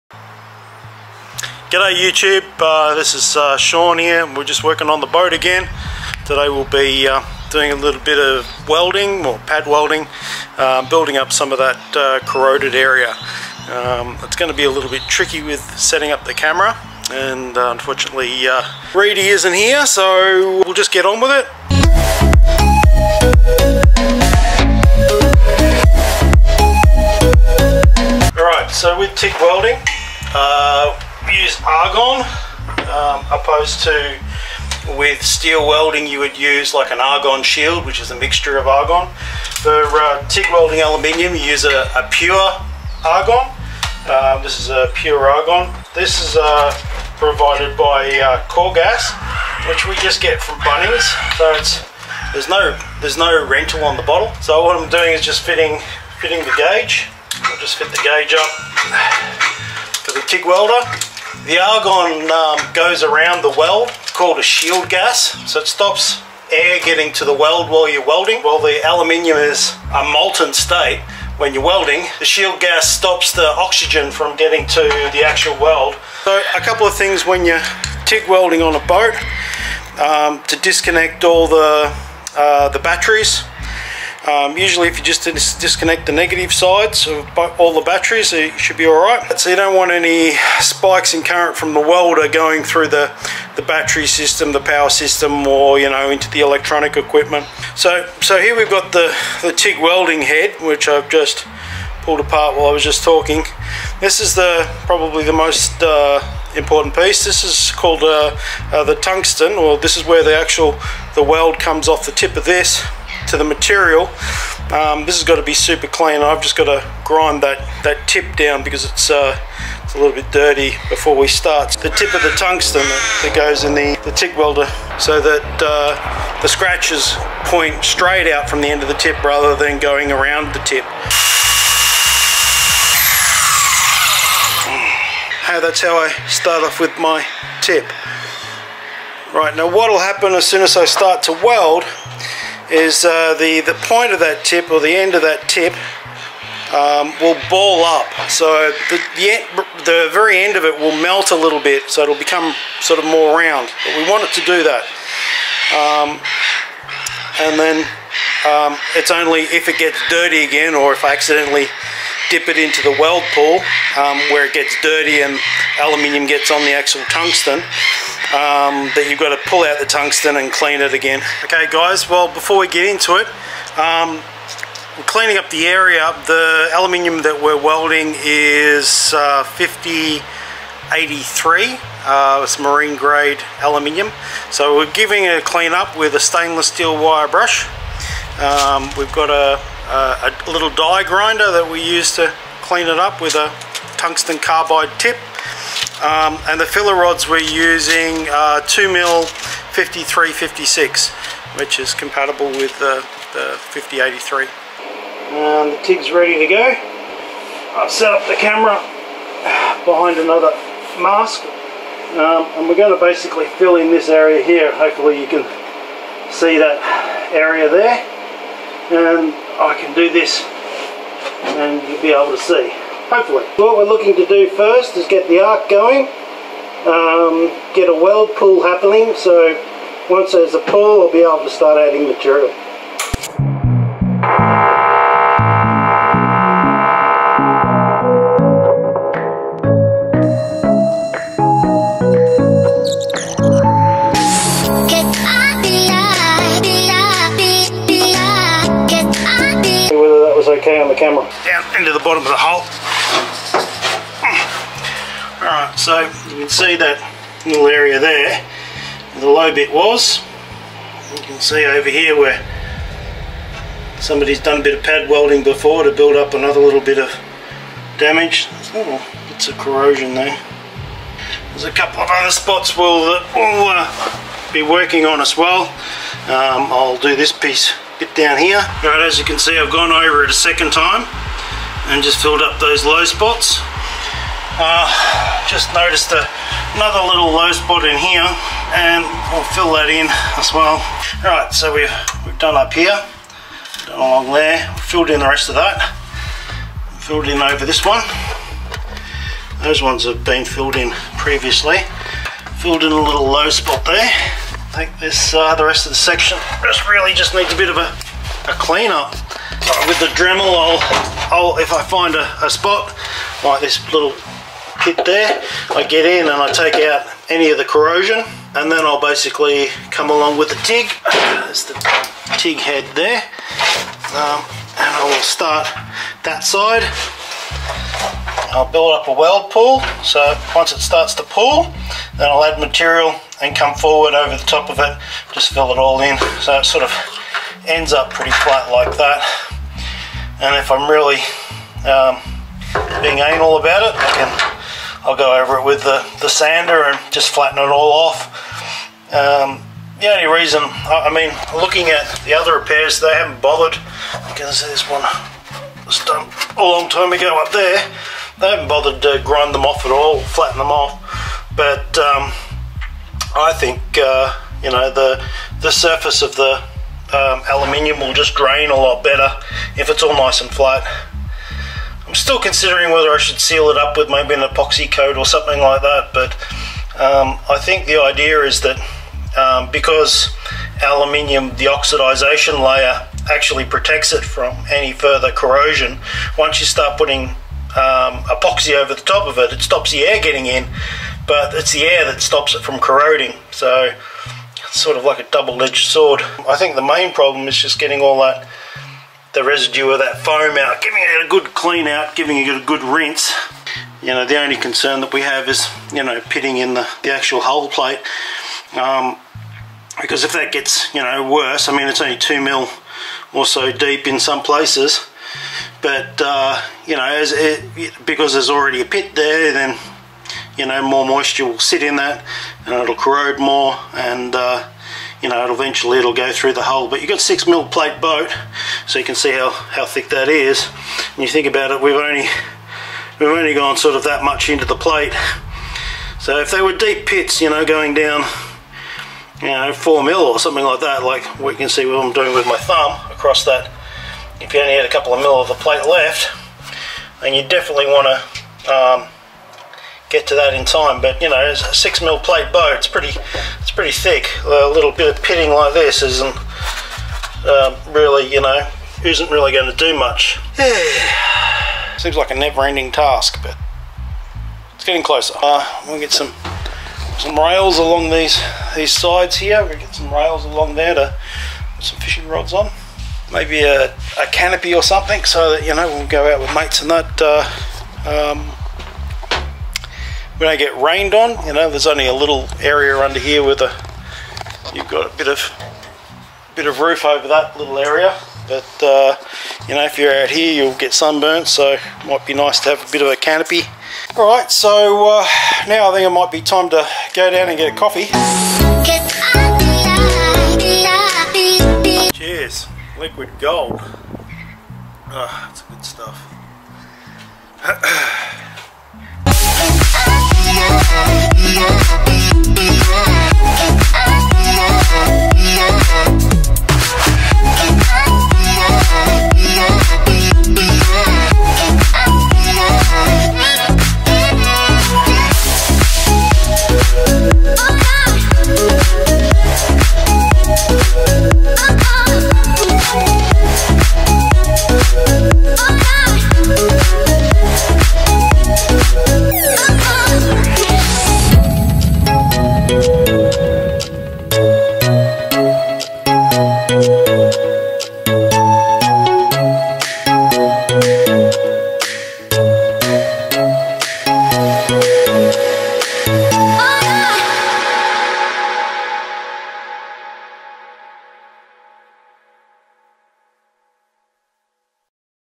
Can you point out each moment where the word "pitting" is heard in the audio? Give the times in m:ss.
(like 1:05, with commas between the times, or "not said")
6:46, 7:35.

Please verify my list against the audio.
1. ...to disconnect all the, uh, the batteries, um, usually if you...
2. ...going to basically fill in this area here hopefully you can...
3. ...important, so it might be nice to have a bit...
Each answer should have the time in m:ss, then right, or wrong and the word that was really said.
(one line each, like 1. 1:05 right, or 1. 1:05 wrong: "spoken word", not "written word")
1. 1:20 right
2. 3:32 right
3. 8:10 wrong: "sunburnt", not "important".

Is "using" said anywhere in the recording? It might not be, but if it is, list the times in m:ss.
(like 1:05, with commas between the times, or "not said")
3:17.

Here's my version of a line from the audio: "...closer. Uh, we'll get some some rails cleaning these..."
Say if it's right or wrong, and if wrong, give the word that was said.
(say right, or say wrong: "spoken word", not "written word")
wrong: "along", not "cleaning".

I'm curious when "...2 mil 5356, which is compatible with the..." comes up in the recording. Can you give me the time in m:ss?
3:18.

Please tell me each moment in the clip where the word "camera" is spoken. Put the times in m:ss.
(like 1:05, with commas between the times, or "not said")
0:16, 3:28, 4:10.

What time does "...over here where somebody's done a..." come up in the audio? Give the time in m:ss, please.
4:21.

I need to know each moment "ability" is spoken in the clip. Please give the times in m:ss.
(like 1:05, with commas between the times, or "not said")
not said.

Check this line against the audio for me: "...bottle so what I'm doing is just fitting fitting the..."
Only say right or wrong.
right.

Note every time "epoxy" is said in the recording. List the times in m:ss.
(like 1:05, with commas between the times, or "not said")
6:14, 6:28.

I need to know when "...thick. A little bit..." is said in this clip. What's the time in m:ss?
7:33.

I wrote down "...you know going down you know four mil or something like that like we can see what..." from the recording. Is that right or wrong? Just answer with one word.
right.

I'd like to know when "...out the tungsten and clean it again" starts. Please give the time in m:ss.
2:49.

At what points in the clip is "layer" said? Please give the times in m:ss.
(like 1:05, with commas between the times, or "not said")
6:22.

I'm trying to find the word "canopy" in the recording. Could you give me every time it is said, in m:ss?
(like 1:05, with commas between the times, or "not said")
7:54, 8:13.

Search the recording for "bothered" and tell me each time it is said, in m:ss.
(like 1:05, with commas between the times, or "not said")
5:53, 5:58.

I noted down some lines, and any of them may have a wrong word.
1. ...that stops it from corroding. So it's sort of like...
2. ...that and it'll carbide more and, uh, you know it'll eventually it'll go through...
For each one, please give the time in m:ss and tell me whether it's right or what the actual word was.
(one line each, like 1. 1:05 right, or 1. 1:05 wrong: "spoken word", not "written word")
1. 6:32 right
2. 7:01 wrong: "corrode", not "carbide".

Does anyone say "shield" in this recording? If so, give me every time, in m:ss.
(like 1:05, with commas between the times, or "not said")
0:37, 1:04, 1:12.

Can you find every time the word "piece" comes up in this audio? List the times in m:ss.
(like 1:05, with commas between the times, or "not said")
1:46, 4:37.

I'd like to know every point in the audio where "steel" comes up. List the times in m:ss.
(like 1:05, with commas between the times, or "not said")
0:35, 3:06.